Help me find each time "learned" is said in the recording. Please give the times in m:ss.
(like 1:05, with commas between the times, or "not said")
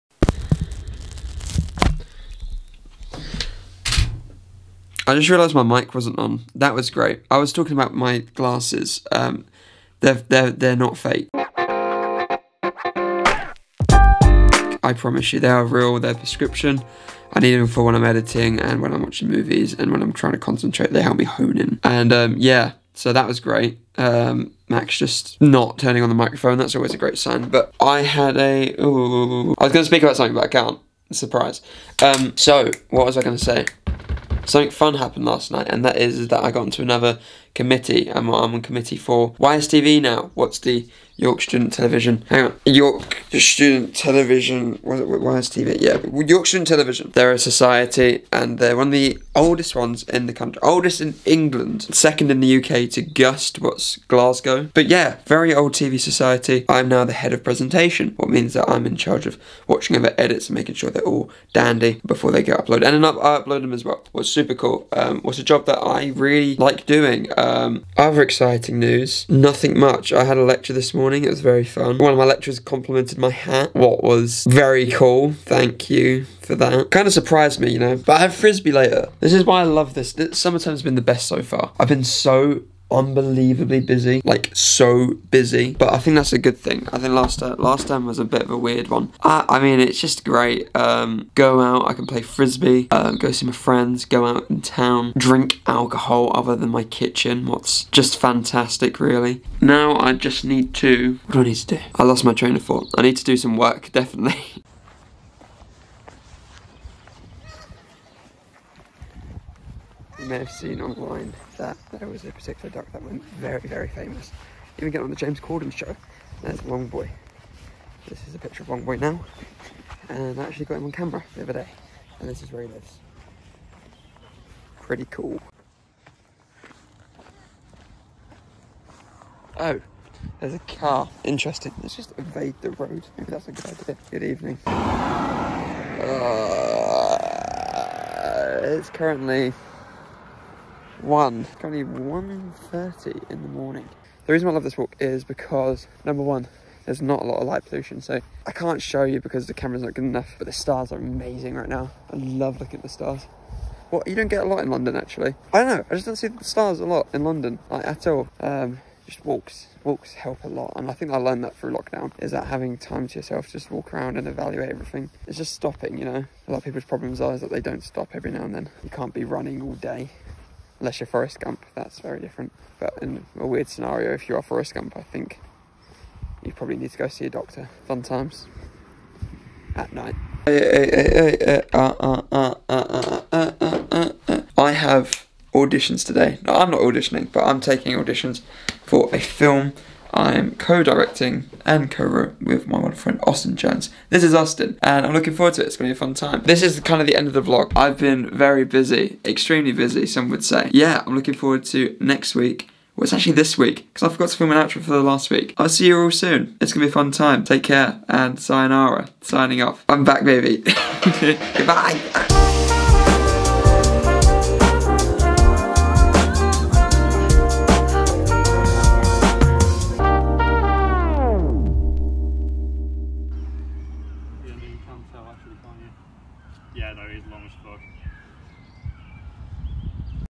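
2:41.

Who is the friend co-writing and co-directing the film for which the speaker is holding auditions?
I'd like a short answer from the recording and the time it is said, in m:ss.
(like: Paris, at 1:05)
Austin Jones, at 3:13.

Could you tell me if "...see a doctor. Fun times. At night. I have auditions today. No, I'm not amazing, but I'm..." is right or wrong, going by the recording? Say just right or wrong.
wrong.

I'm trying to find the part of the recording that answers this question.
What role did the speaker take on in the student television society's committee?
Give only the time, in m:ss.
0:57.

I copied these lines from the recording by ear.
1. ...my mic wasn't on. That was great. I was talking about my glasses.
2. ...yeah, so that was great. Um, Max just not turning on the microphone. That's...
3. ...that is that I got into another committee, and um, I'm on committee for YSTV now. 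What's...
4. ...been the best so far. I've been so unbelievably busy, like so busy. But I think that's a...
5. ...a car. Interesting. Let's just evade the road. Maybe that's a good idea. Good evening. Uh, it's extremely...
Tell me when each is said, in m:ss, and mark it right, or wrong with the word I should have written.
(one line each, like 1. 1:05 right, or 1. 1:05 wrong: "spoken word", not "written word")
1. 0:05 right
2. 0:22 right
3. 0:35 right
4. 1:20 right
5. 2:10 wrong: "currently", not "extremely".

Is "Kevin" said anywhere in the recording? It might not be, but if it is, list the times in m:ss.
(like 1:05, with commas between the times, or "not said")
not said.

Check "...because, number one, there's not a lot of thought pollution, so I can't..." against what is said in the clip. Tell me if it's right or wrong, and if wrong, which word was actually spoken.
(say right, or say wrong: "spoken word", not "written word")
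wrong: "light", not "thought".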